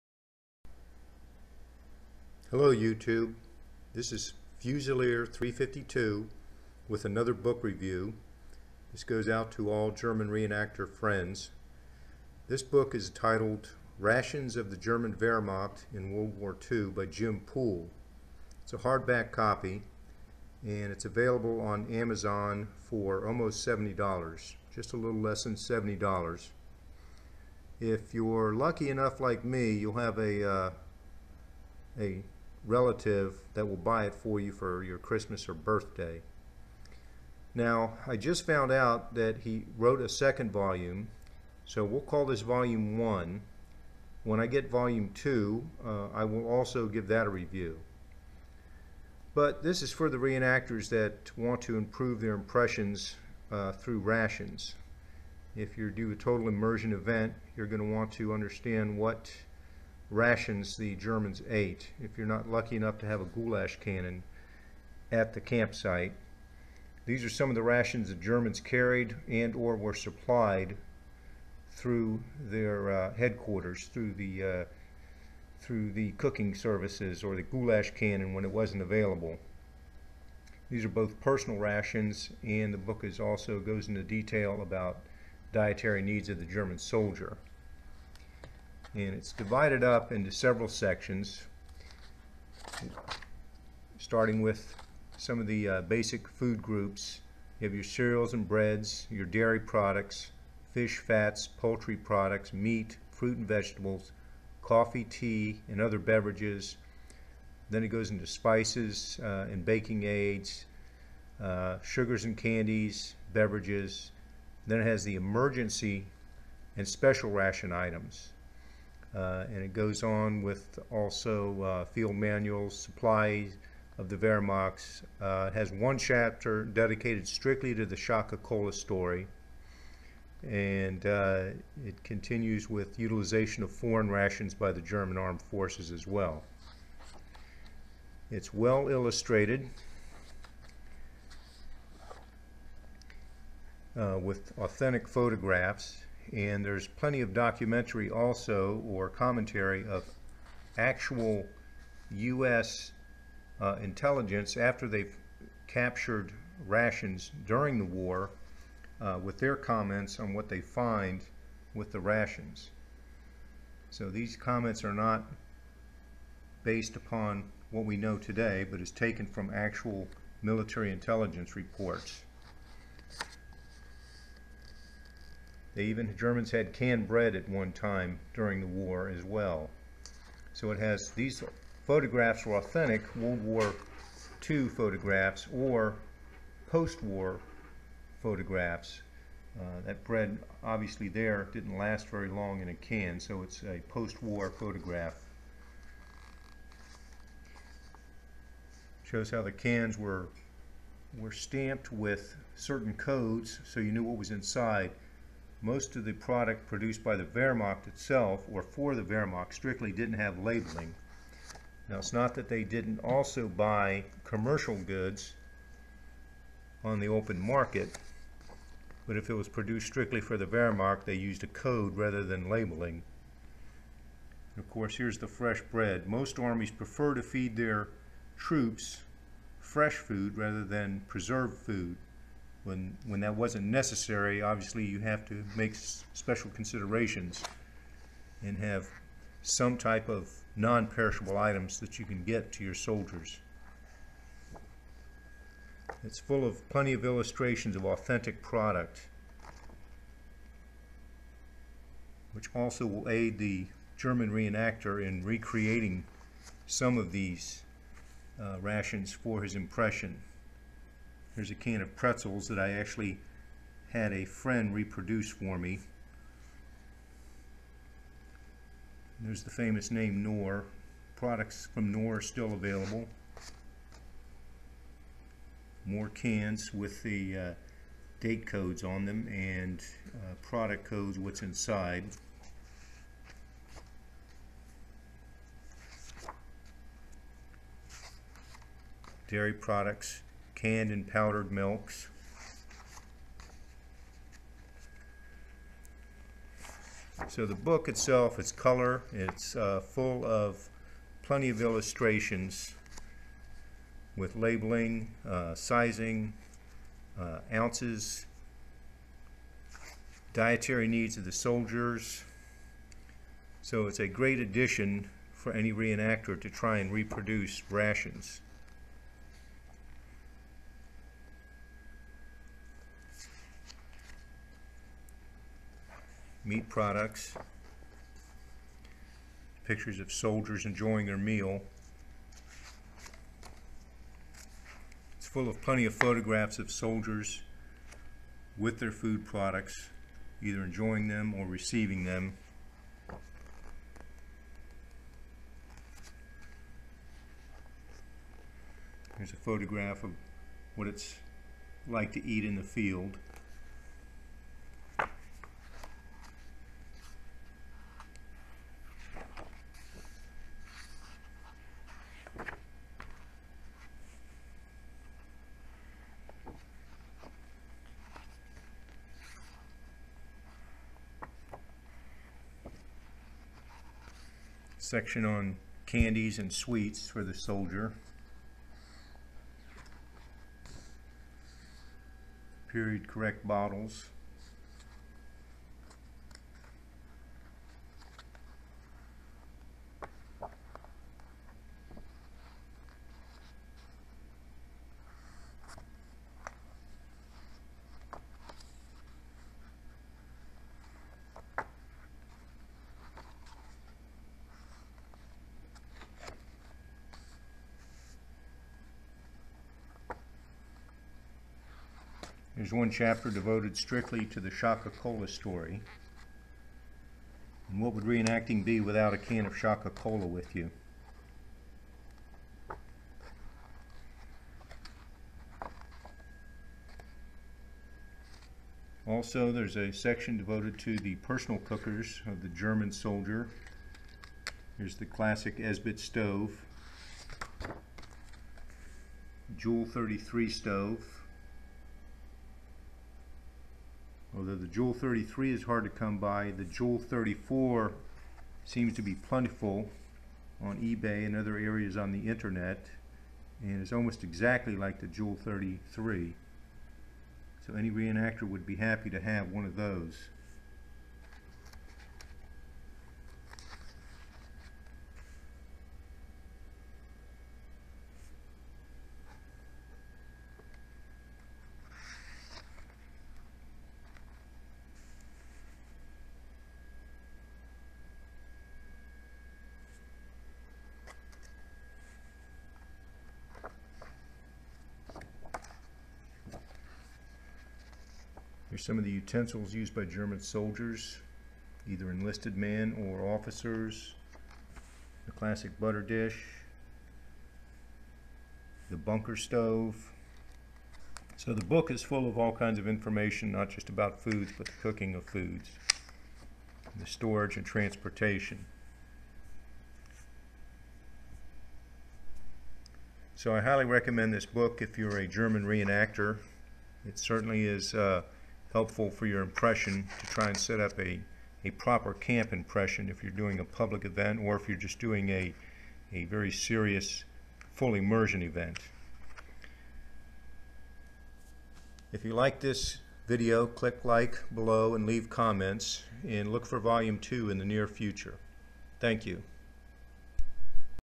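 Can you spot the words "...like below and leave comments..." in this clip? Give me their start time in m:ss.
8:54.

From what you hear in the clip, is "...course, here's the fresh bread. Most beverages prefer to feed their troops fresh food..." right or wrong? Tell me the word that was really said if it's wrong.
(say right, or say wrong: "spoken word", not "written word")
wrong: "armies", not "beverages".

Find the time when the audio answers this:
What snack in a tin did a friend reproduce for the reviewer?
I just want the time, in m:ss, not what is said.
4:21.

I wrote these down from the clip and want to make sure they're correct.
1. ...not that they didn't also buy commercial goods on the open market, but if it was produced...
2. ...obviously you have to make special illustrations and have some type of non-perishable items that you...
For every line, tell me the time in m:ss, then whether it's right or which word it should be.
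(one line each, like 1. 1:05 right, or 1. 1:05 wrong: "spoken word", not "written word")
1. 3:32 right
2. 3:54 wrong: "considerations", not "illustrations".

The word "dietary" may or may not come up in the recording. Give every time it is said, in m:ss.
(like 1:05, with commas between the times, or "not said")
1:25, 5:10.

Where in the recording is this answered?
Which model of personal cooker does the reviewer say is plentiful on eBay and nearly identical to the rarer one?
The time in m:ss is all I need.
7:26.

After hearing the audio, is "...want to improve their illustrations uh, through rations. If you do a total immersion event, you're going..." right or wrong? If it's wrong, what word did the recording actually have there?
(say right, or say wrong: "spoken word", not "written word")
wrong: "impressions", not "illustrations".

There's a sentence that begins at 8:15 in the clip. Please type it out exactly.
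The classic butter dish, the bunker stove.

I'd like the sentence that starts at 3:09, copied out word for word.
Uh, that bread, obviously there, didn't last very long in a can, so it's a post-war photograph.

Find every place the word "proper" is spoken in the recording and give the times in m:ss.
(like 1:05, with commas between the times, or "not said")
8:41.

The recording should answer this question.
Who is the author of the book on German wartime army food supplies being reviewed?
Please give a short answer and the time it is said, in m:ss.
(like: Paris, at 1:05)
Jim Poole, at 0:17.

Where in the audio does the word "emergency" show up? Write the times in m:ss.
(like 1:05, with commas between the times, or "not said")
1:55.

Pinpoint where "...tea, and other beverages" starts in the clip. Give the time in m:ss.
1:45.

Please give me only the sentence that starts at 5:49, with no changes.
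Here's a photograph of what it's like to eat in the field.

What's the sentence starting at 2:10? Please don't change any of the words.
And uh, it continues with utilization of foreign rations by the German armed forces as well.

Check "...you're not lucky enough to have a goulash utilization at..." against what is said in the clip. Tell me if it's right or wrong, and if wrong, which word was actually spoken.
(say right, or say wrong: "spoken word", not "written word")
wrong: "cannon", not "utilization".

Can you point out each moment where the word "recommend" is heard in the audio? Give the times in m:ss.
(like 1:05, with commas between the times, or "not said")
8:33.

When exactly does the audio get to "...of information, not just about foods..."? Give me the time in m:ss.
8:22.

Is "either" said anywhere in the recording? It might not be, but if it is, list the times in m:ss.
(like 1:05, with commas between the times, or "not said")
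5:40, 8:11.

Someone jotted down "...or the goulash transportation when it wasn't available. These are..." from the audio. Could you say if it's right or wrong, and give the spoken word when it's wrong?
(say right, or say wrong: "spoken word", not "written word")
wrong: "cannon", not "transportation".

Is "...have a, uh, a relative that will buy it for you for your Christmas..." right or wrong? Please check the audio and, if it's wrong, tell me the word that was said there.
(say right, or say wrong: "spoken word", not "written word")
right.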